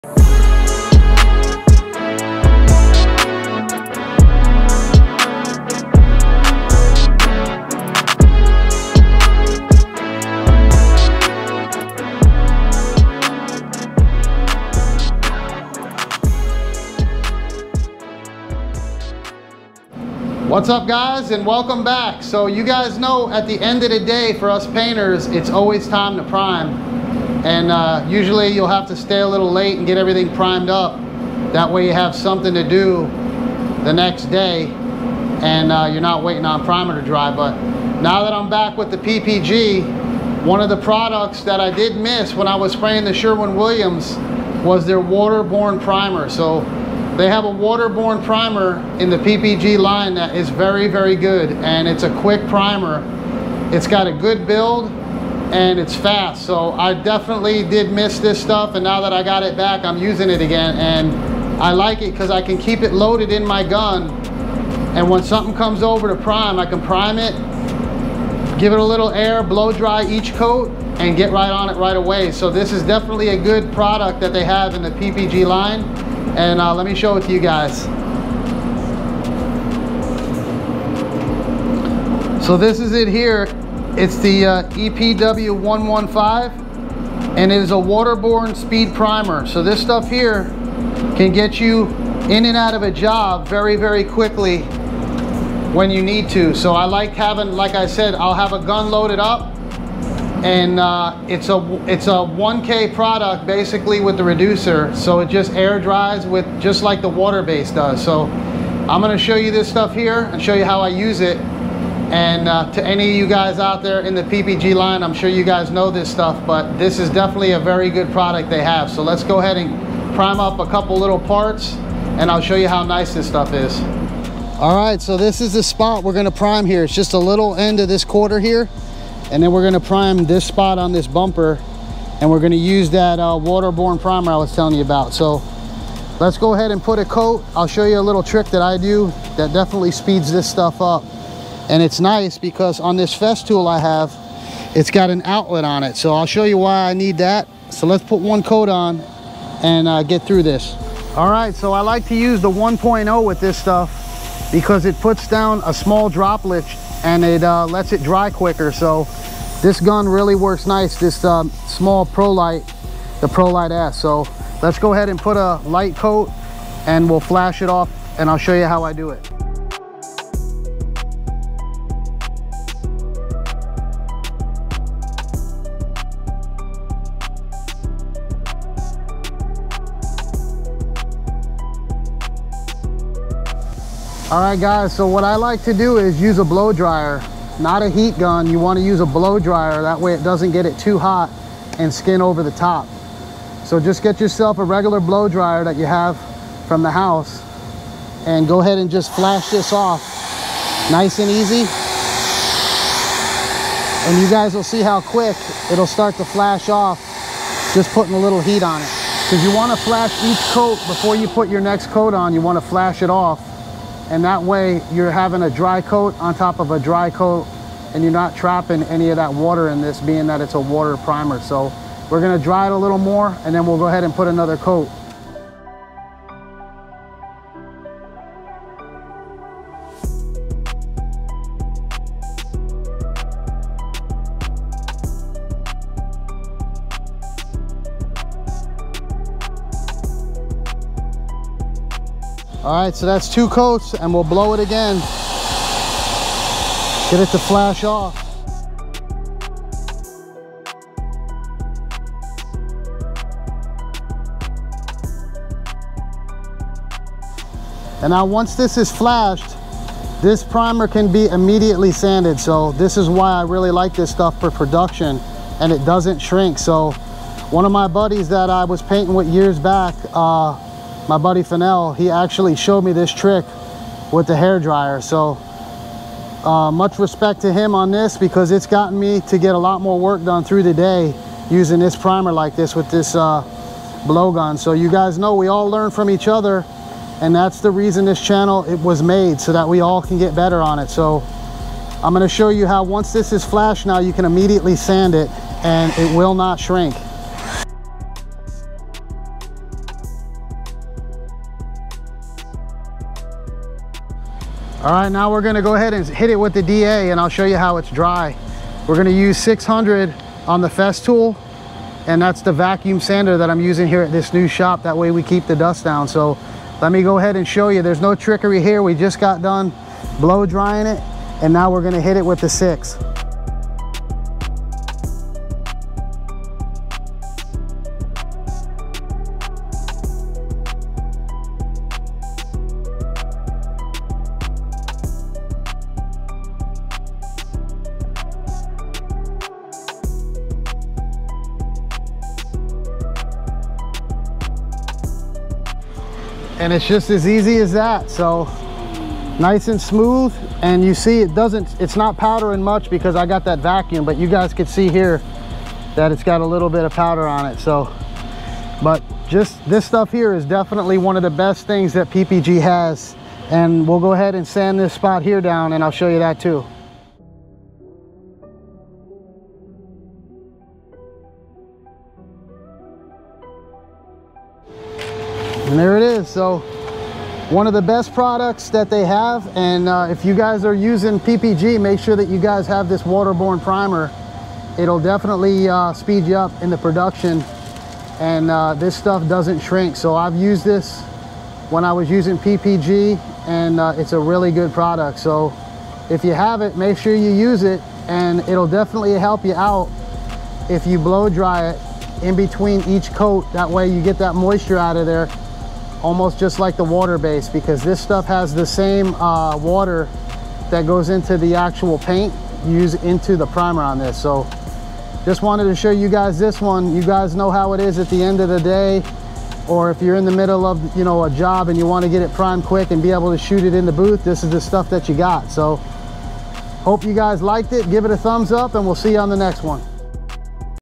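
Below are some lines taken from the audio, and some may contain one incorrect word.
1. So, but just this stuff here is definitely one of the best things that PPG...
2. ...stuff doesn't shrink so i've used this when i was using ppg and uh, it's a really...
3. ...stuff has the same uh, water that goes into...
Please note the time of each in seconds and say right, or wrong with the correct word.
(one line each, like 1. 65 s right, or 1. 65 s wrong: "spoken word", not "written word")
1. 357 s right
2. 388 s right
3. 408 s right.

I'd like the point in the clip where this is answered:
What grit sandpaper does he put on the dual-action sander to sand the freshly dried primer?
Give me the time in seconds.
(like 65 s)
309 s.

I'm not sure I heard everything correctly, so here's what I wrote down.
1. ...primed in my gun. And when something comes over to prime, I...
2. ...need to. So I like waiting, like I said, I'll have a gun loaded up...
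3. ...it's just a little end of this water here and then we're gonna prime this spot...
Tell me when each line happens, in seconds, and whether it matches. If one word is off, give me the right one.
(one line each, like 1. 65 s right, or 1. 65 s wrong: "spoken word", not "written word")
1. 62 s wrong: "loaded", not "primed"
2. 96 s wrong: "having", not "waiting"
3. 126 s wrong: "quarter", not "water".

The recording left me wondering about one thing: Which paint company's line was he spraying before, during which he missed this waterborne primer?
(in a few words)
Sherwin-Williams.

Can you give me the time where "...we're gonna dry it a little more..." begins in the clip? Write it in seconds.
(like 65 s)
222 s.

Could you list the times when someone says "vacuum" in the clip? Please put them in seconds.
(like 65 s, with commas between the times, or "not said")
312 s, 353 s.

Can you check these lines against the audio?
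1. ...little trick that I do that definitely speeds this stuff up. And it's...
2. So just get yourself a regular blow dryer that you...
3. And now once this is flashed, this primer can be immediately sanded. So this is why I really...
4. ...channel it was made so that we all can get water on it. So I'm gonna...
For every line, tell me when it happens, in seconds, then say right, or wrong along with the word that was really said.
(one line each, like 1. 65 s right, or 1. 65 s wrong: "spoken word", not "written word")
1. 138 s right
2. 193 s right
3. 258 s right
4. 288 s wrong: "better", not "water".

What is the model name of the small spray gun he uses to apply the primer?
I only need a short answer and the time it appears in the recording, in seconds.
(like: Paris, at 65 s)
Pro Light S, at 163 s.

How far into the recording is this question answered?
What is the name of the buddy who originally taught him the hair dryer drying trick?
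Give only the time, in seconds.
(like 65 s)
271 s.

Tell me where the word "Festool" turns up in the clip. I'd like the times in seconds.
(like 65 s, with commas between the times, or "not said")
143 s, 310 s.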